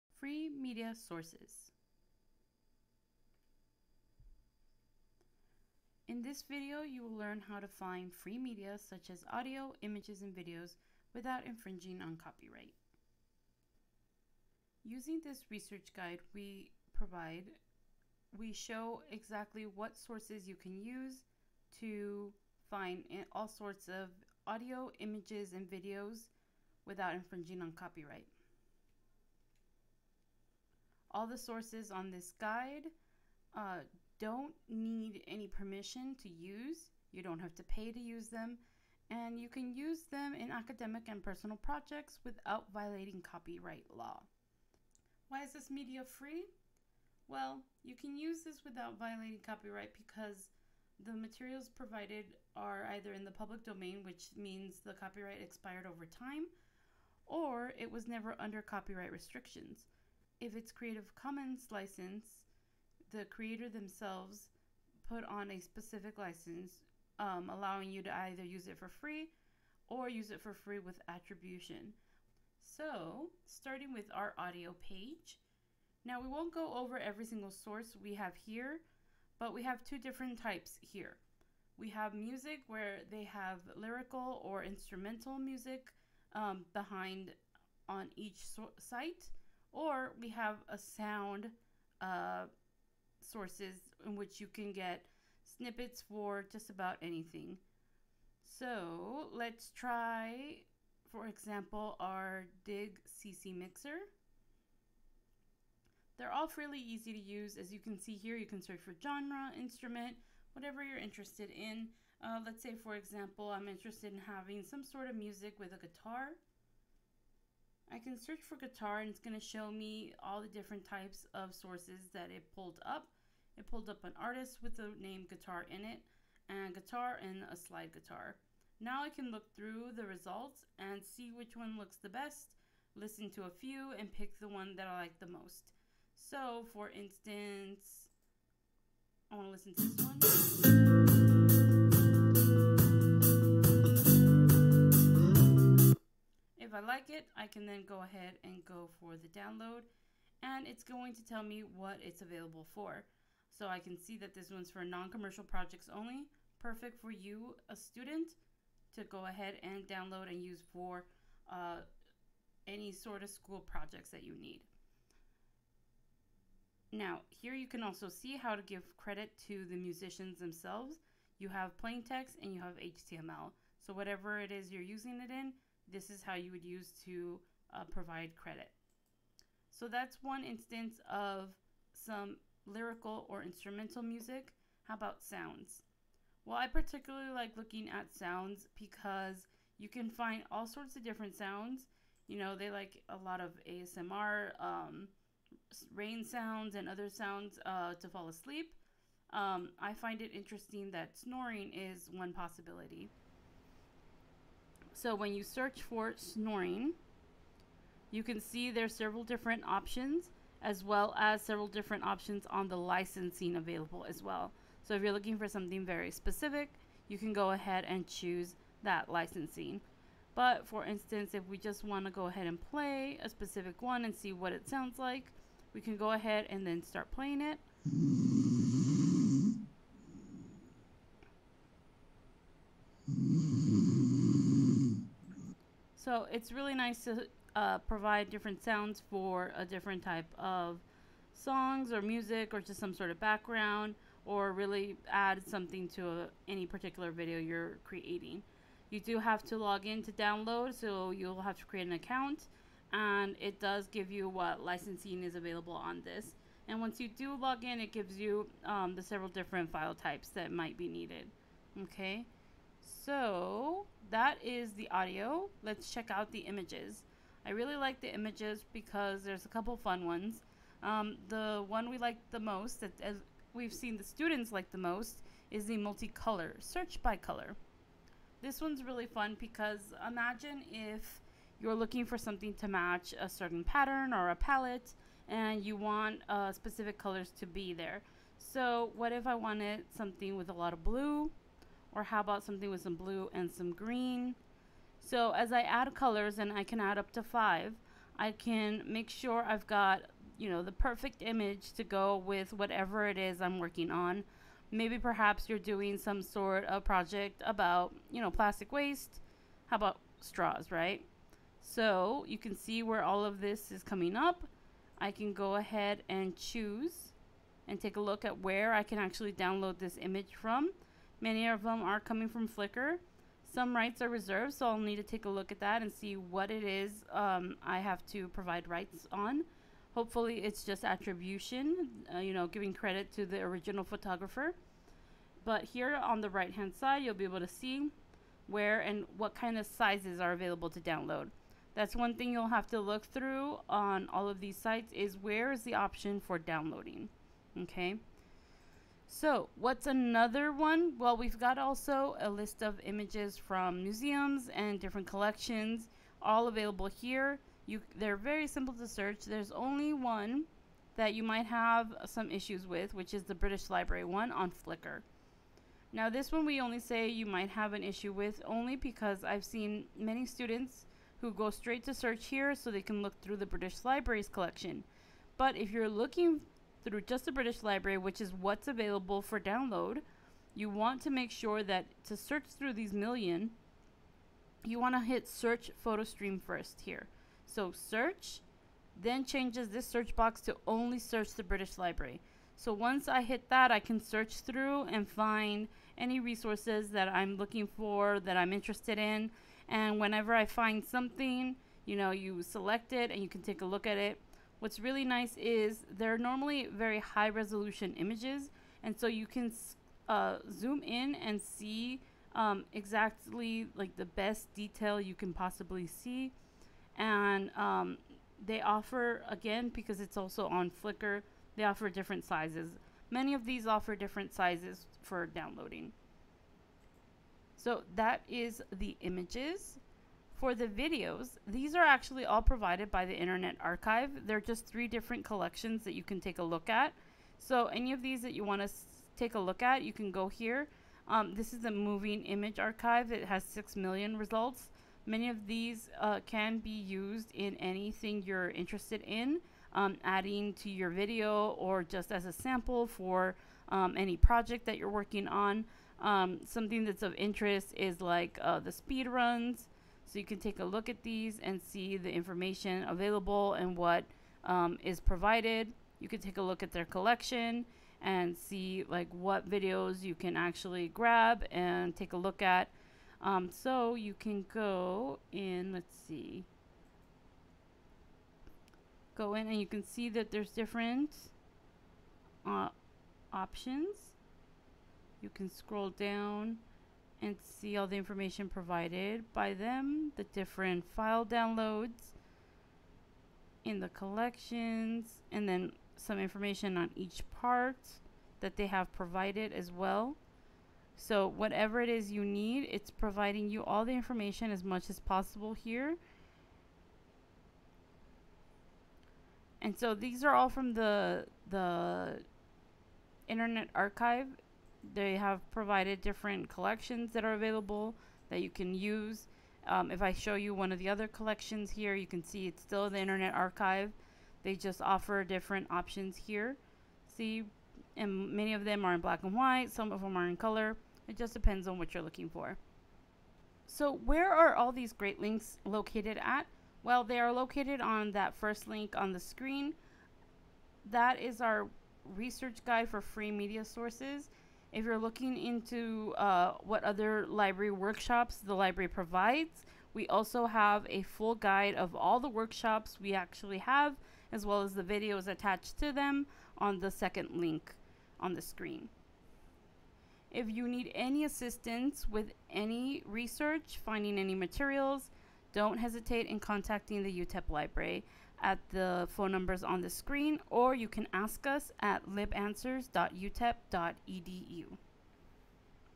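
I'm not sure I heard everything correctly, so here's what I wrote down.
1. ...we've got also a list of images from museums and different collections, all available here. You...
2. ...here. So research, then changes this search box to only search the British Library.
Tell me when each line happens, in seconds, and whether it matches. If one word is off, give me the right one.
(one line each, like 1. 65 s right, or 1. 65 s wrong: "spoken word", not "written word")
1. 351 s right
2. 386 s wrong: "search", not "research".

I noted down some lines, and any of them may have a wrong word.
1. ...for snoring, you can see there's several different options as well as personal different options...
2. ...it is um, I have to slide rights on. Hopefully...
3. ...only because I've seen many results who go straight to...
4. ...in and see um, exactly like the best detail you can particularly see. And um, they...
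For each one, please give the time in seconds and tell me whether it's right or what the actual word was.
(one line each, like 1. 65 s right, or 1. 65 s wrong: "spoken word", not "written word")
1. 205 s wrong: "several", not "personal"
2. 326 s wrong: "provide", not "slide"
3. 368 s wrong: "students", not "results"
4. 410 s wrong: "possibly", not "particularly".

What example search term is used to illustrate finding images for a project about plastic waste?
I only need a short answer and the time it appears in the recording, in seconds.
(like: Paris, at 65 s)
straws, at 310 s.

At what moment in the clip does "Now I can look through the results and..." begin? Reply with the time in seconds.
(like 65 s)
128 s.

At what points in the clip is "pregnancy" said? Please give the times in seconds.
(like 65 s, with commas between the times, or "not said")
not said.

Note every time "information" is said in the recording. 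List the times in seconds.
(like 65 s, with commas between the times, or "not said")
462 s, 487 s, 496 s, 503 s.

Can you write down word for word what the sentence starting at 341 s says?
That's one thing you'll have to look through on all of these sites is where is the option for downloading.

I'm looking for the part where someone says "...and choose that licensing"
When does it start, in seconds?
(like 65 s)
217 s.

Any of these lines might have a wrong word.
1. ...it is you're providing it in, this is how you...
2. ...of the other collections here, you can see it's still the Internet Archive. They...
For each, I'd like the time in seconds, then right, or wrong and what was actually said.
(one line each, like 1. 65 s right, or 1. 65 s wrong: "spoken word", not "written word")
1. 174 s wrong: "using", not "providing"
2. 520 s right.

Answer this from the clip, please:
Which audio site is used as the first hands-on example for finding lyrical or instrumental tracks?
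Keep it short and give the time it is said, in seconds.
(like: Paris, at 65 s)
Dig ccMixter, at 102 s.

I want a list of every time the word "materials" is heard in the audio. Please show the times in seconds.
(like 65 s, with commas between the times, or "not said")
51 s, 564 s.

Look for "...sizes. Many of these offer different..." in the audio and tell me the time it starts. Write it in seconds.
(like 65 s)
422 s.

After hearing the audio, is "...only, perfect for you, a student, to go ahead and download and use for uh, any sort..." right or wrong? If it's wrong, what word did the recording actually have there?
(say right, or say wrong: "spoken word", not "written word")
right.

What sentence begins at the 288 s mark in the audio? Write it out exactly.
So what if I wanted something with a lot of blue, or how about something with some blue and some green?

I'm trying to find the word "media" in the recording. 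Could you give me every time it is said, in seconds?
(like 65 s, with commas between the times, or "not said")
0 s, 8 s, 45 s, 543 s.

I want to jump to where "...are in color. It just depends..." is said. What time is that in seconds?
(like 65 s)
530 s.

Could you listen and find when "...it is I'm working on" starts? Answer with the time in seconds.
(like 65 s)
303 s.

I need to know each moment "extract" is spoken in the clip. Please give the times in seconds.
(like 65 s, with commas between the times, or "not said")
not said.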